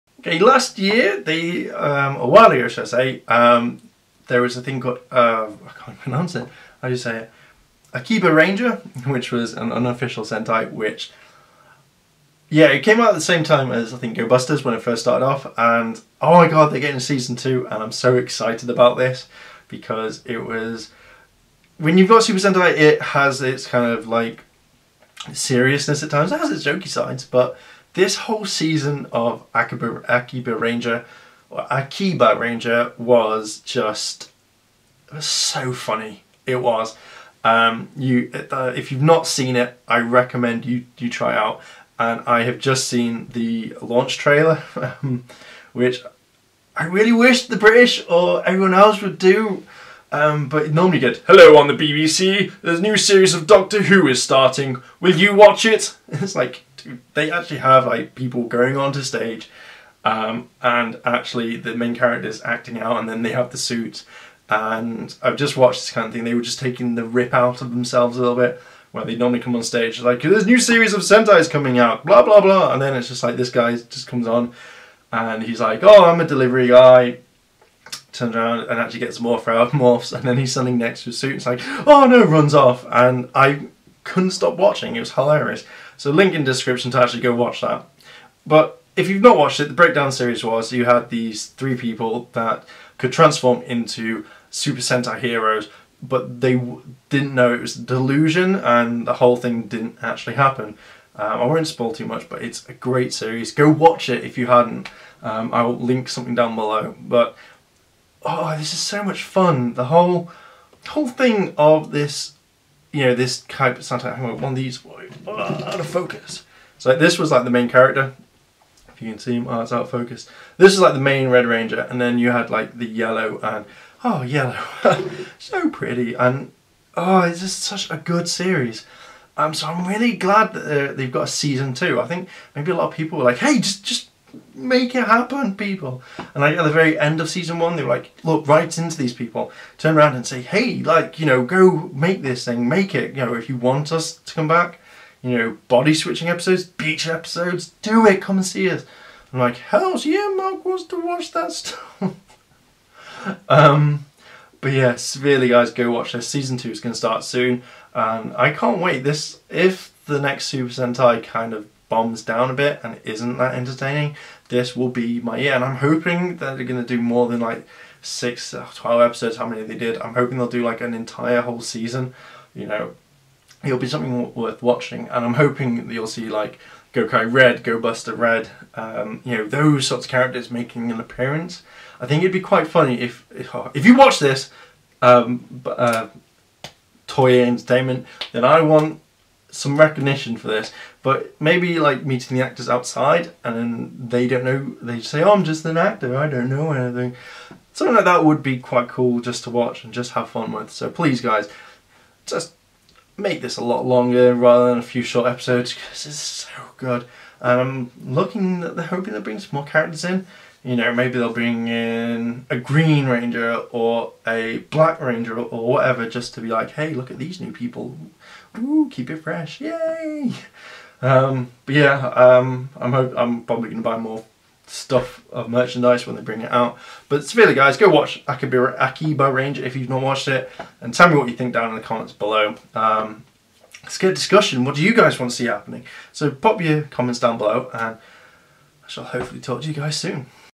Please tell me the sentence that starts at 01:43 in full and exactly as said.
Go watch it if you hadn't.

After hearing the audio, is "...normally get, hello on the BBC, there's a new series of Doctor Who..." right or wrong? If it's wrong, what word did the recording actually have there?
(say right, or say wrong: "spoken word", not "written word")
right.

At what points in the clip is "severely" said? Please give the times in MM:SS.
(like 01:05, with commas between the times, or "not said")
02:34, 03:47.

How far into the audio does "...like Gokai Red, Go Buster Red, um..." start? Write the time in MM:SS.
02:56.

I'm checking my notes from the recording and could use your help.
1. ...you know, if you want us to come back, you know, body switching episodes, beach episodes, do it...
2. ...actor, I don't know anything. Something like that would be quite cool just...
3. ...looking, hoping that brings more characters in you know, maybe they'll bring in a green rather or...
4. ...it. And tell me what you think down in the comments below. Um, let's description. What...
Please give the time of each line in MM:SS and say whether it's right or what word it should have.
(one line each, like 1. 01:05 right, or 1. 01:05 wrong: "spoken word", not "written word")
1. 02:23 right
2. 03:15 right
3. 03:28 wrong: "ranger", not "rather"
4. 03:50 wrong: "discussion", not "description".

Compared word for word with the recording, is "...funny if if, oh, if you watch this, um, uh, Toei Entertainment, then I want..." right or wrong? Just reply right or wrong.
right.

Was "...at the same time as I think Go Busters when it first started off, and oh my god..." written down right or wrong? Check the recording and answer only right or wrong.
right.